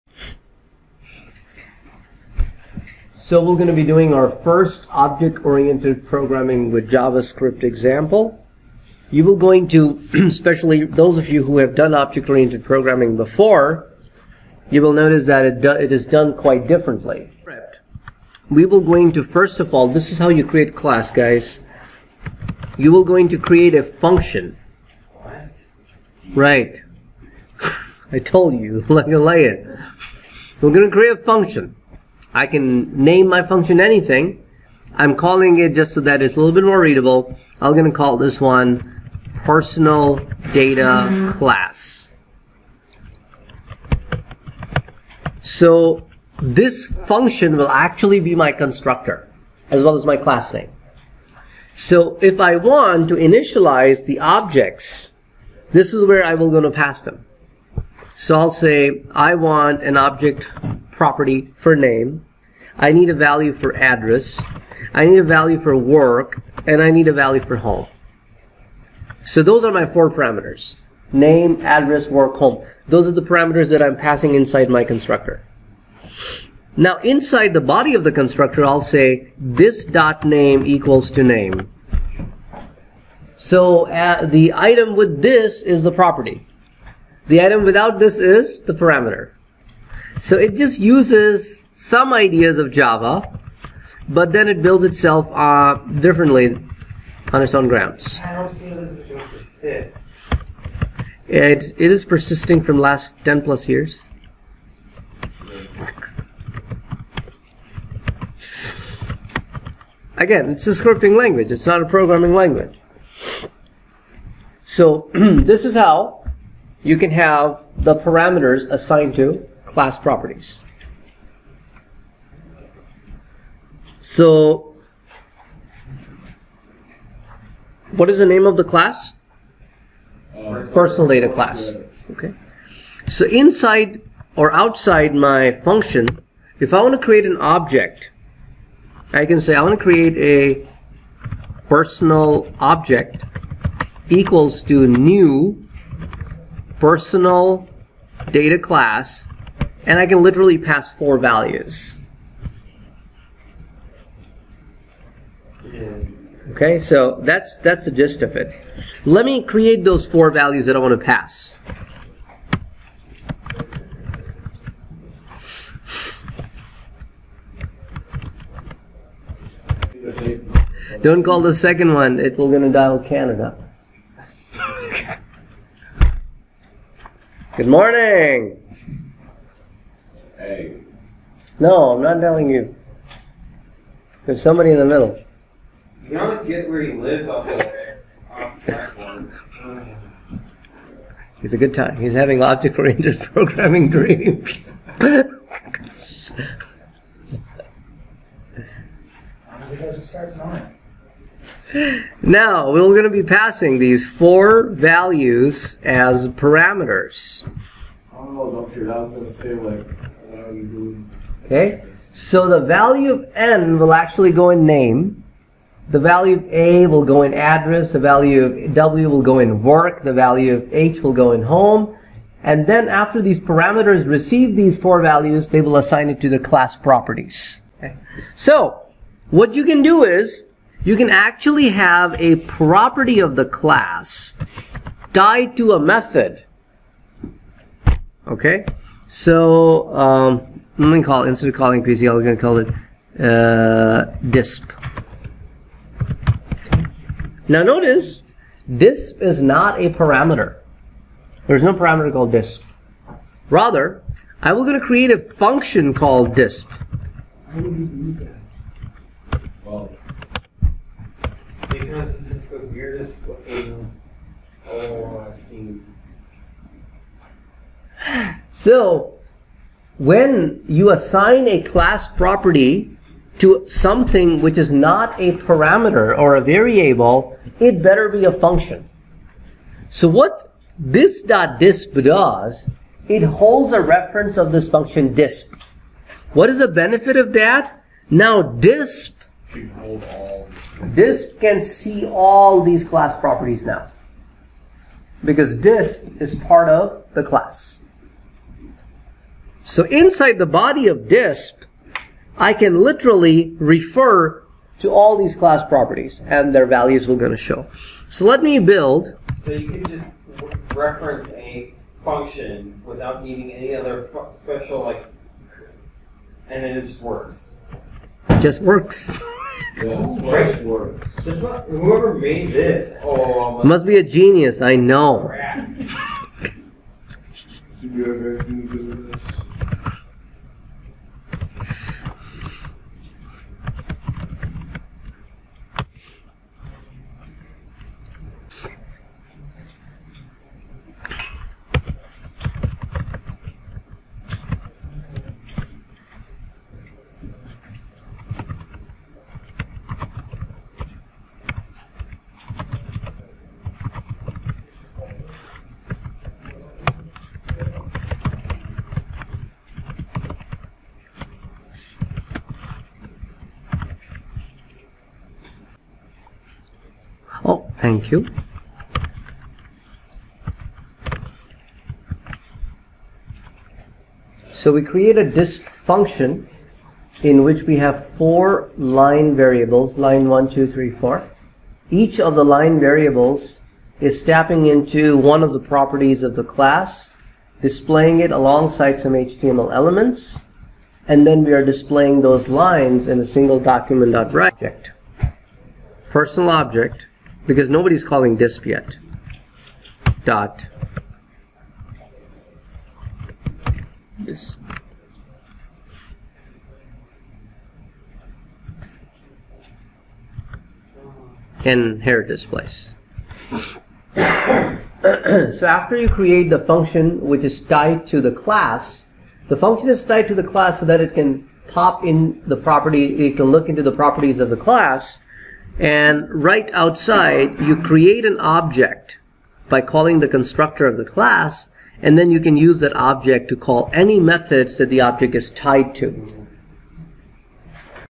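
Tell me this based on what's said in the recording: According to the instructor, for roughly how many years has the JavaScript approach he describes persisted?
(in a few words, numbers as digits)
10 plus years.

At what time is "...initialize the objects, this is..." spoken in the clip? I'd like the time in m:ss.
0:53.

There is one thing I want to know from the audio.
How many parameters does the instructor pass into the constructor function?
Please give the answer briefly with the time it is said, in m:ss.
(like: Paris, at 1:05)
4, at 1:09.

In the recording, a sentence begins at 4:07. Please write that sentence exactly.
Now notice, DISP is not a parameter.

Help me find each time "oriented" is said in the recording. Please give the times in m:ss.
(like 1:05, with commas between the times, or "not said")
0:04, 0:11, 3:12.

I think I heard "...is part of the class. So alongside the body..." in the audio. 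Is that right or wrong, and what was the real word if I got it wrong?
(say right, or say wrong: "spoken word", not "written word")
wrong: "inside", not "alongside".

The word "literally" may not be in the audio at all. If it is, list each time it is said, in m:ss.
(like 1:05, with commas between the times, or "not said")
2:30, 5:02.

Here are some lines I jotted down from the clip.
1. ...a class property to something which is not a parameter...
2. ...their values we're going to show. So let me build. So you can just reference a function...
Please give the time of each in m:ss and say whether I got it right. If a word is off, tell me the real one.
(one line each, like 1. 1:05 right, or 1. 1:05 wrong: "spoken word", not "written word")
1. 4:31 right
2. 5:06 right.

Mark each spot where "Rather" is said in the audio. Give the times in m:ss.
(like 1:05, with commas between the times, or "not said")
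4:13.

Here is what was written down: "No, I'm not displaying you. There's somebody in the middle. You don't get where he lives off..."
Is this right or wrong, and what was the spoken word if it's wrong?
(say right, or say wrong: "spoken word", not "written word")
wrong: "telling", not "displaying".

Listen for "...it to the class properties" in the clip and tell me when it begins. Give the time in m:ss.
3:46.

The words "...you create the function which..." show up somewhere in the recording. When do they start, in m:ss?
6:55.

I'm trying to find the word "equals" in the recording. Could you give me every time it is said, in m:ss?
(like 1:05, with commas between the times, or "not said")
1:20, 2:24.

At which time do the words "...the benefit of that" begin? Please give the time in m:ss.
4:46.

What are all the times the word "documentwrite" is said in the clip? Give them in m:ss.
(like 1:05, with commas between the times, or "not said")
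6:33.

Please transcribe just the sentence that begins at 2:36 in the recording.
Okay, so that's that's the gist of it.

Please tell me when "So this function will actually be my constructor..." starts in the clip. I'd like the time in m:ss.
0:45.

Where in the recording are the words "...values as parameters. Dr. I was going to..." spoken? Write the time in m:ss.
3:24.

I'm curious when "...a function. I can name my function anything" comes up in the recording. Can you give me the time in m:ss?
0:31.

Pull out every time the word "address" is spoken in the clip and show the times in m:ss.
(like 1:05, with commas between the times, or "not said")
1:03, 1:11, 3:37.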